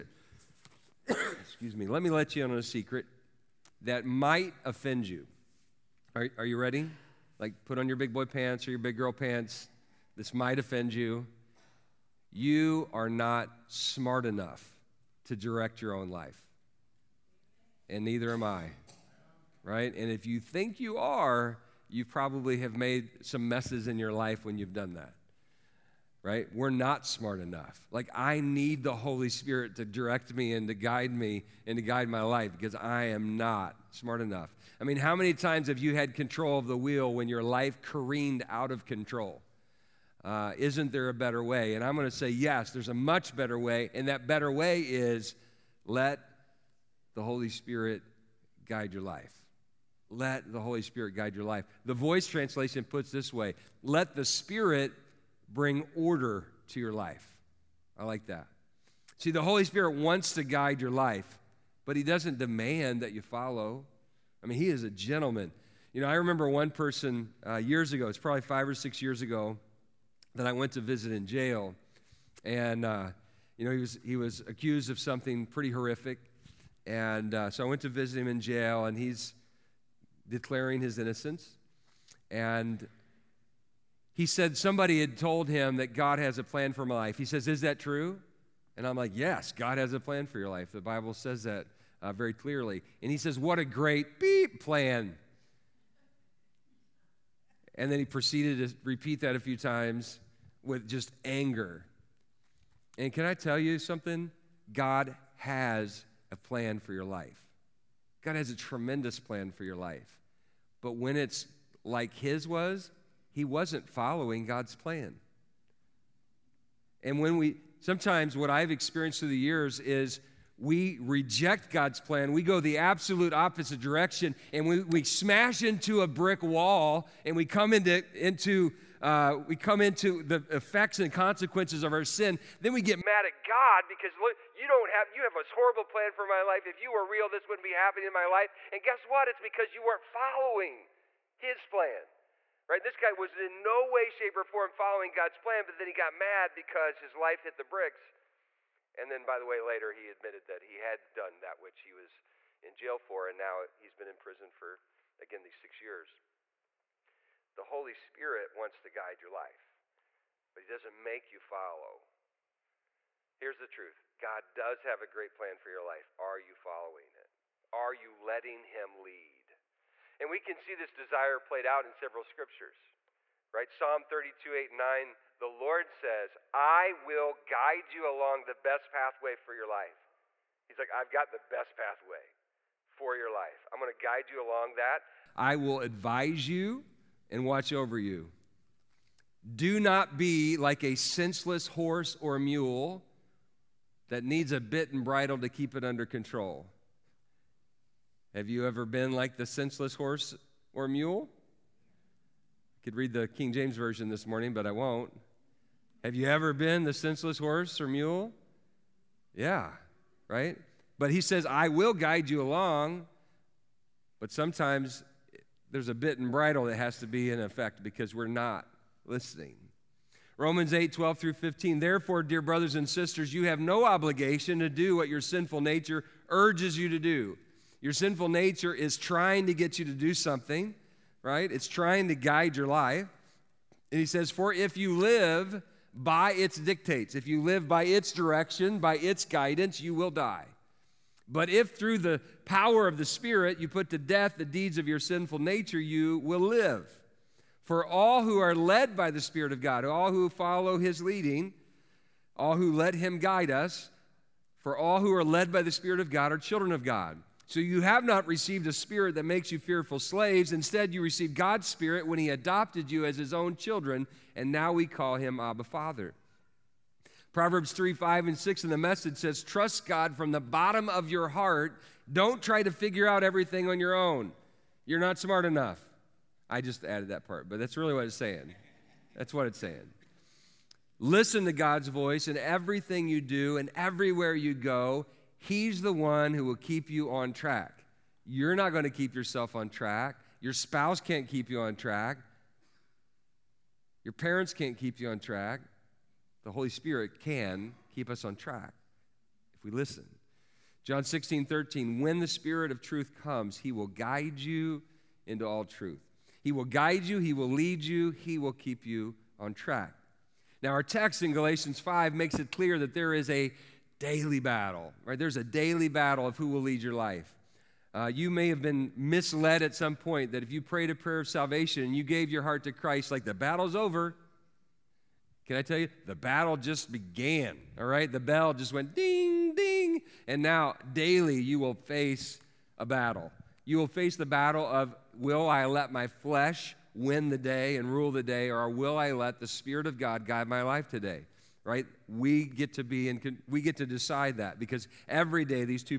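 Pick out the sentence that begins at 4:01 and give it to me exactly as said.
But if through the power of the Spirit you put to death the deeds of your sinful nature, you will live.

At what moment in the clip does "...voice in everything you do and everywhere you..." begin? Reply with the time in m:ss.
4:41.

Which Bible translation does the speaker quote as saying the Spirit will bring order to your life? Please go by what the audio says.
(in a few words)
The Voice.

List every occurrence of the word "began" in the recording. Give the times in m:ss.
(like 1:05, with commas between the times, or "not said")
5:26.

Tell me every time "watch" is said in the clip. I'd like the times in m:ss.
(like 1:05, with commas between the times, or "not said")
3:07.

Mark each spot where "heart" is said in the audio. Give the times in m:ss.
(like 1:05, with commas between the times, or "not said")
4:31, 5:22.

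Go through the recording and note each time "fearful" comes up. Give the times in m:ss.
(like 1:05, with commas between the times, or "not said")
4:19.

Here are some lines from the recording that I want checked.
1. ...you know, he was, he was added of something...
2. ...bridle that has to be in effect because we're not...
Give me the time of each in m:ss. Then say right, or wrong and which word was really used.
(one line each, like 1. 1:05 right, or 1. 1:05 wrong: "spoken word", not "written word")
1. 1:13 wrong: "accused", not "added"
2. 3:36 right.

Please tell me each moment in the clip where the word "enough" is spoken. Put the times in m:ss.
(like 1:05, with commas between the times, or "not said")
0:14, 0:27, 0:34, 4:35.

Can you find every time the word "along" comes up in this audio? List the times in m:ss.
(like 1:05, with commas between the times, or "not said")
2:58, 3:04, 3:32.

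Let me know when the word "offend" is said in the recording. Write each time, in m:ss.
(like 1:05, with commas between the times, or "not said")
0:04, 0:10.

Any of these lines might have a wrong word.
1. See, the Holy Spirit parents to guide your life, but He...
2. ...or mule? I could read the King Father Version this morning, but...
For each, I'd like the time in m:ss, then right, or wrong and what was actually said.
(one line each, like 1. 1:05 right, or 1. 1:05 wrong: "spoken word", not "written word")
1. 0:59 wrong: "wants", not "parents"
2. 3:20 wrong: "James", not "Father".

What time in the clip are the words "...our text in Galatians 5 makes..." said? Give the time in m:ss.
5:10.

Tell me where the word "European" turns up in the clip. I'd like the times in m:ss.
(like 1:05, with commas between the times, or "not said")
not said.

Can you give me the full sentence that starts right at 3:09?
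Do not be like a senseless horse or mule that needs a bit and bridle to keep it under control.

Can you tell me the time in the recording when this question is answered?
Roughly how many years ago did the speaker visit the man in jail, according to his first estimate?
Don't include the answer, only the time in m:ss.
1:08.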